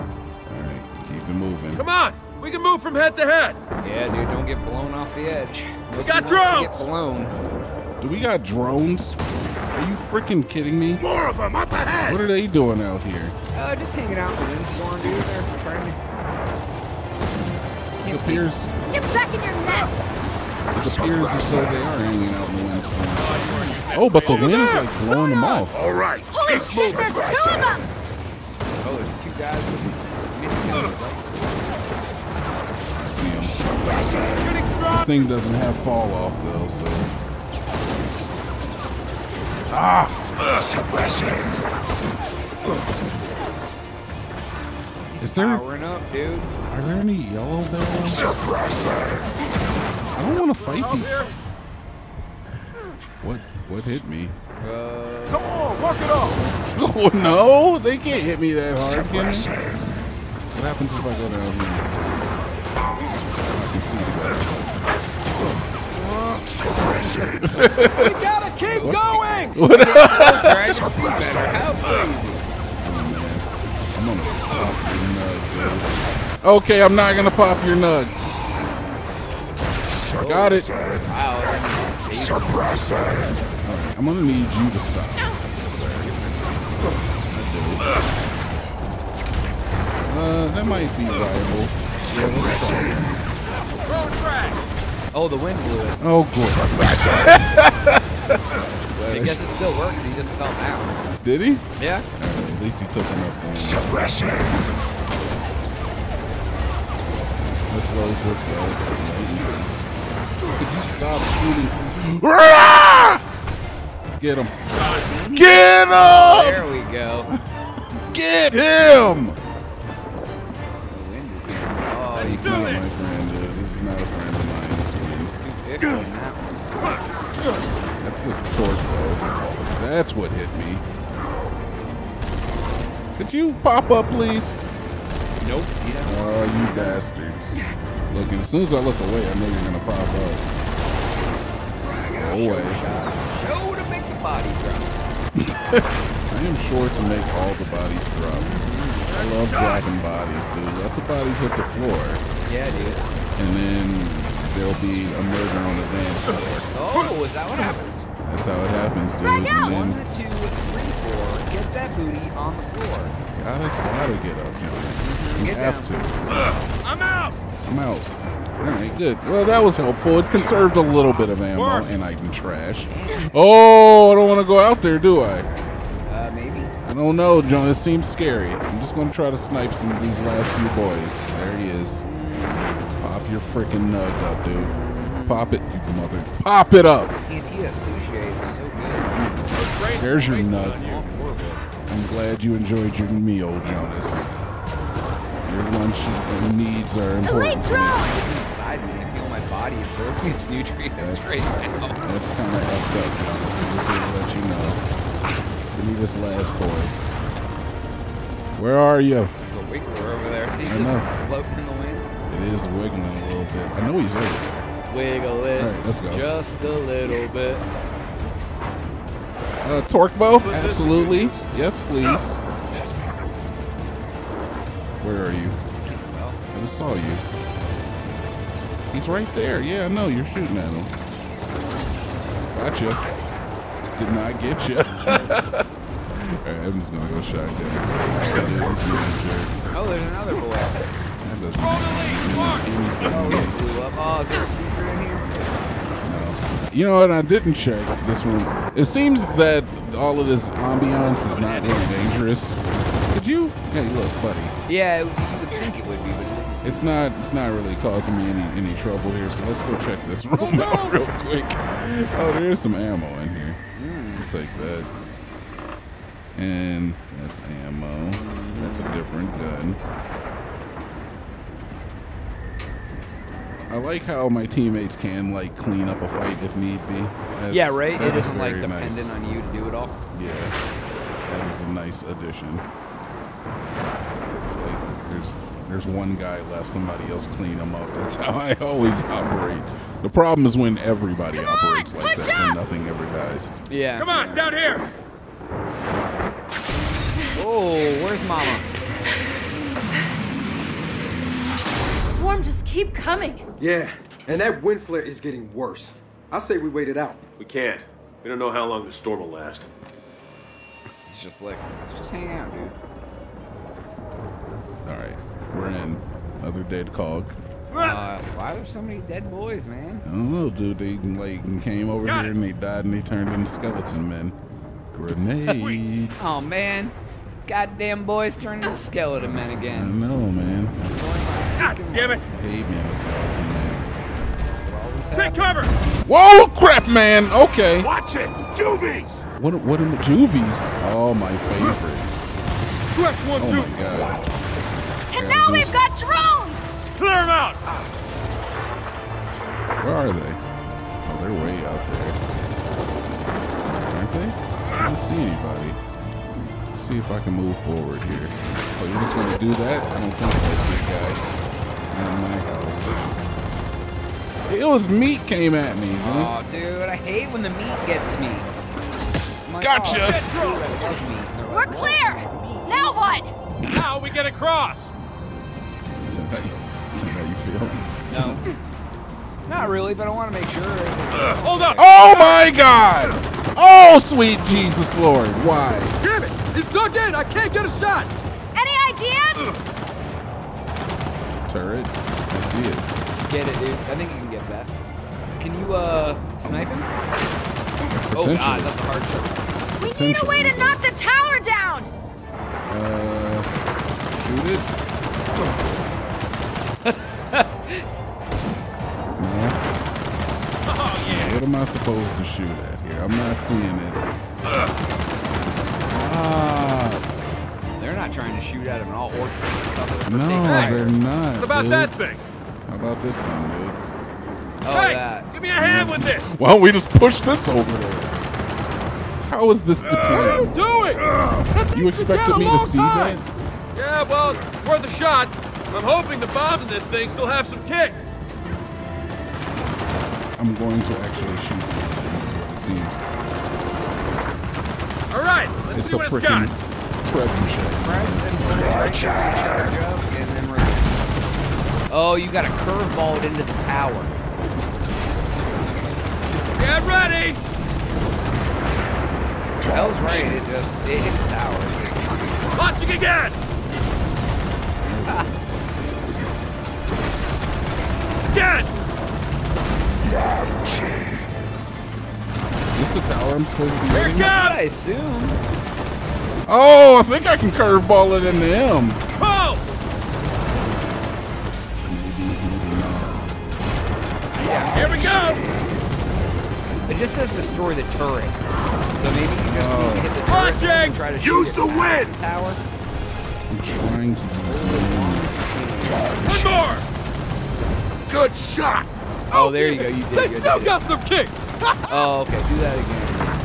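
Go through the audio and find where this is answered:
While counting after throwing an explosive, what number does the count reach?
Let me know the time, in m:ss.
2:41.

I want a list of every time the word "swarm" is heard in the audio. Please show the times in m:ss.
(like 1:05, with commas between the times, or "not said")
5:02.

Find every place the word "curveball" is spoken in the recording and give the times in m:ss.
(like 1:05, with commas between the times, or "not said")
7:32, 7:57.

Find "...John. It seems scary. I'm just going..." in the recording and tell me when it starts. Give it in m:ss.
2:57.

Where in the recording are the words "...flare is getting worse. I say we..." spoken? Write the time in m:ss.
5:04.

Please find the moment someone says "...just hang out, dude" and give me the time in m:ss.
5:11.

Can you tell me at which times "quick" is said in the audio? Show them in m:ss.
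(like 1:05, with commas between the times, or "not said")
4:21.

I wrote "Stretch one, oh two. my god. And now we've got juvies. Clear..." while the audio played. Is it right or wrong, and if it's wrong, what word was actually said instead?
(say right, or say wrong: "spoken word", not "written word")
wrong: "drones", not "juvies".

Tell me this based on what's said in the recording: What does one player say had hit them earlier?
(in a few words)
Sword blow.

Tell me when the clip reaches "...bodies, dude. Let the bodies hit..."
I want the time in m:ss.
2:30.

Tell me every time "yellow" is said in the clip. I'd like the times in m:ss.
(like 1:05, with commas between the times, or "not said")
0:47.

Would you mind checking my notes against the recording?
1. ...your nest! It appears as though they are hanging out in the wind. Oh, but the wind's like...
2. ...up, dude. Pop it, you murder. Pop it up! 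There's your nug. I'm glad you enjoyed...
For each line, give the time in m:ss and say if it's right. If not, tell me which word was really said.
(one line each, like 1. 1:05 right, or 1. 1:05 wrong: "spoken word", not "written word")
1. 0:19 right
2. 3:04 wrong: "mother", not "murder".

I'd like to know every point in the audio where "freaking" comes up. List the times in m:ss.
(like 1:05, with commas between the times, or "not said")
0:09, 3:03.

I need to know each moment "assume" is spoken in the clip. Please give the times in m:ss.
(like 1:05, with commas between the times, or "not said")
7:54.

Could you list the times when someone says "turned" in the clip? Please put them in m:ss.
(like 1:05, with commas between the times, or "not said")
5:23, 5:28.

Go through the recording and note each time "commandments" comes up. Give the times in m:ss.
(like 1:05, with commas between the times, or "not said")
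not said.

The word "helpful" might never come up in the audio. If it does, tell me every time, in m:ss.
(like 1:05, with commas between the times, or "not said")
2:49.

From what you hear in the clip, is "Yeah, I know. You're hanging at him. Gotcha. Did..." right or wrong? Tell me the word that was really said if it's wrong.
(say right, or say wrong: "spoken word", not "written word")
wrong: "shooting", not "hanging".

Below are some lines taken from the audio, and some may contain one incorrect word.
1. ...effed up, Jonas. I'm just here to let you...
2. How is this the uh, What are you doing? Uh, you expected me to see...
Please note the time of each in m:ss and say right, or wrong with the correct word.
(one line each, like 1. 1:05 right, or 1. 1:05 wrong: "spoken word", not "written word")
1. 3:22 right
2. 7:09 right.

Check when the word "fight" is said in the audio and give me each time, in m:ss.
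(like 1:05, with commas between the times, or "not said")
0:50, 4:36.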